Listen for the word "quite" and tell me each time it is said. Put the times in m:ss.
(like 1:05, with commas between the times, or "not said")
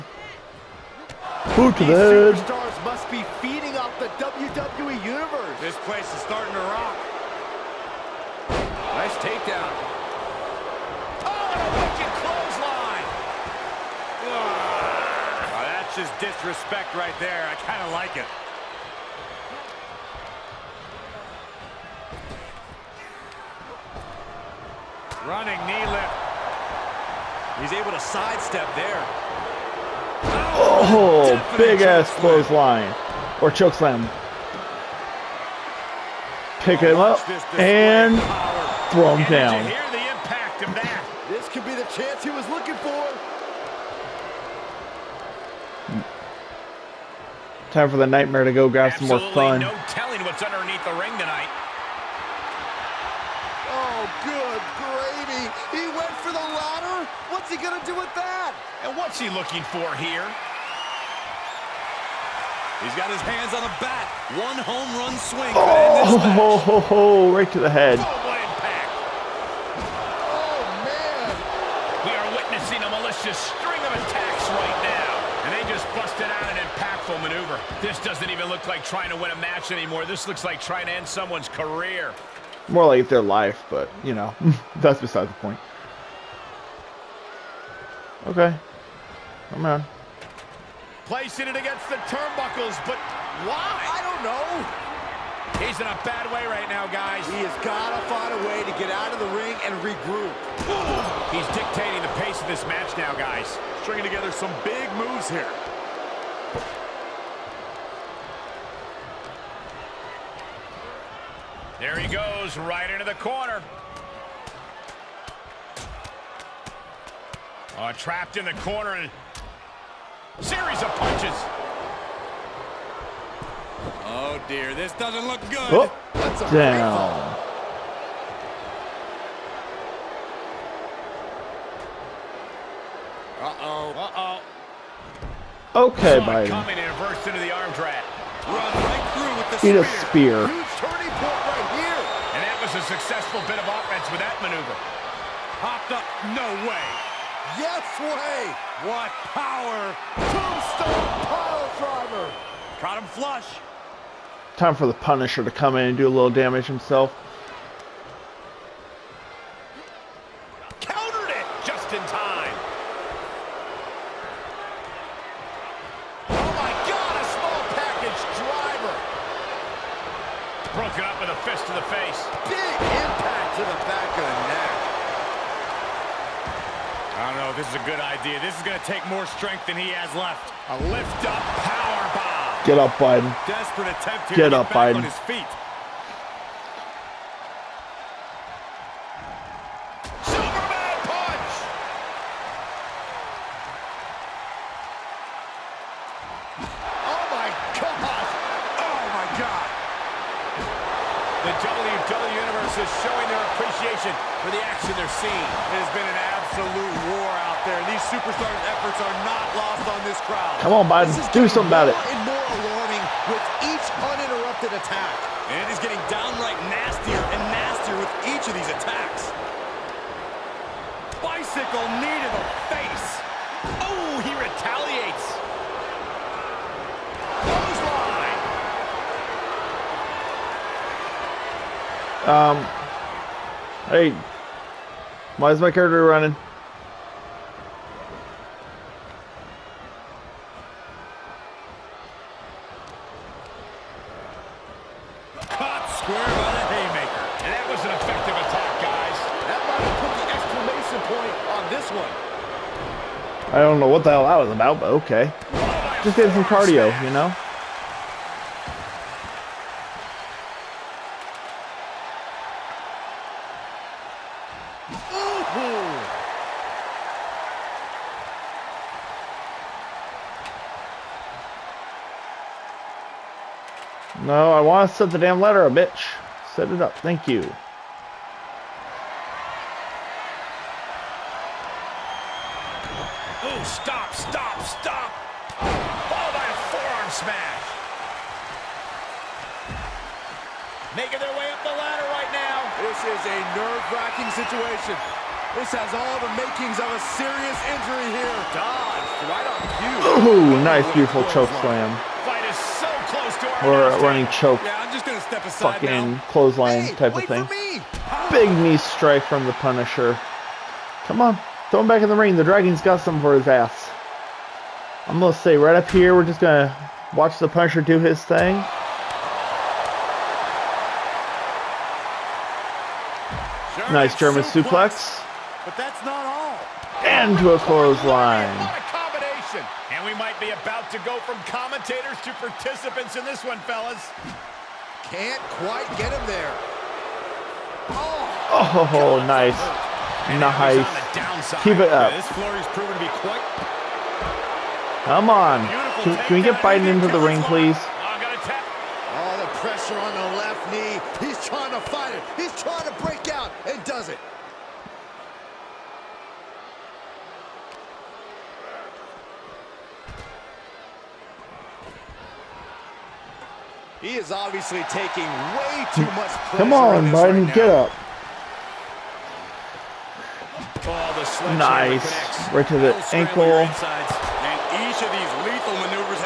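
5:35, 5:43.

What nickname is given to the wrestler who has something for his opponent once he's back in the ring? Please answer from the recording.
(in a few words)
The Dragon.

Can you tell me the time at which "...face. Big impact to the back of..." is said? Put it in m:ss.
2:51.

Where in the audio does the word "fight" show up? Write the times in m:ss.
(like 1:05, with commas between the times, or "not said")
5:02, 5:51.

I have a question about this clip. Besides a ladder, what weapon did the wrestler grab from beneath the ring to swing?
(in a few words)
bat.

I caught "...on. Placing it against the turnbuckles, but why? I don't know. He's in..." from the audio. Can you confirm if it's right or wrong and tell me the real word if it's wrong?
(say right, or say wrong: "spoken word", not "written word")
right.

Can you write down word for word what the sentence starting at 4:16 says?
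Just did some cardio, you know?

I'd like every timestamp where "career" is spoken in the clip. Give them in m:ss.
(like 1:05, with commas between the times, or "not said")
1:21.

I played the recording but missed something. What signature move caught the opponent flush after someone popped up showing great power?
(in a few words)
Tombstone pile driver.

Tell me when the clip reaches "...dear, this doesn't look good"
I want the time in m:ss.
2:04.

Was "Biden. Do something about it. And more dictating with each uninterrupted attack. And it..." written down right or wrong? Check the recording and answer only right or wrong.
wrong.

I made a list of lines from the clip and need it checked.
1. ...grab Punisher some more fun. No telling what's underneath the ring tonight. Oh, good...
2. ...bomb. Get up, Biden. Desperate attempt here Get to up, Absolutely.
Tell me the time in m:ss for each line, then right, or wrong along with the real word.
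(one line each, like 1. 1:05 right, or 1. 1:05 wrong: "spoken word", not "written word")
1. 0:48 wrong: "Absolutely", not "Punisher"
2. 3:02 wrong: "Biden", not "Absolutely".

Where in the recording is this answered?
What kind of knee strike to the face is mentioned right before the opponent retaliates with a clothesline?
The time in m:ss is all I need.
3:41.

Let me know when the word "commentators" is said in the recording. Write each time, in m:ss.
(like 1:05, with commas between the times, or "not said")
5:31.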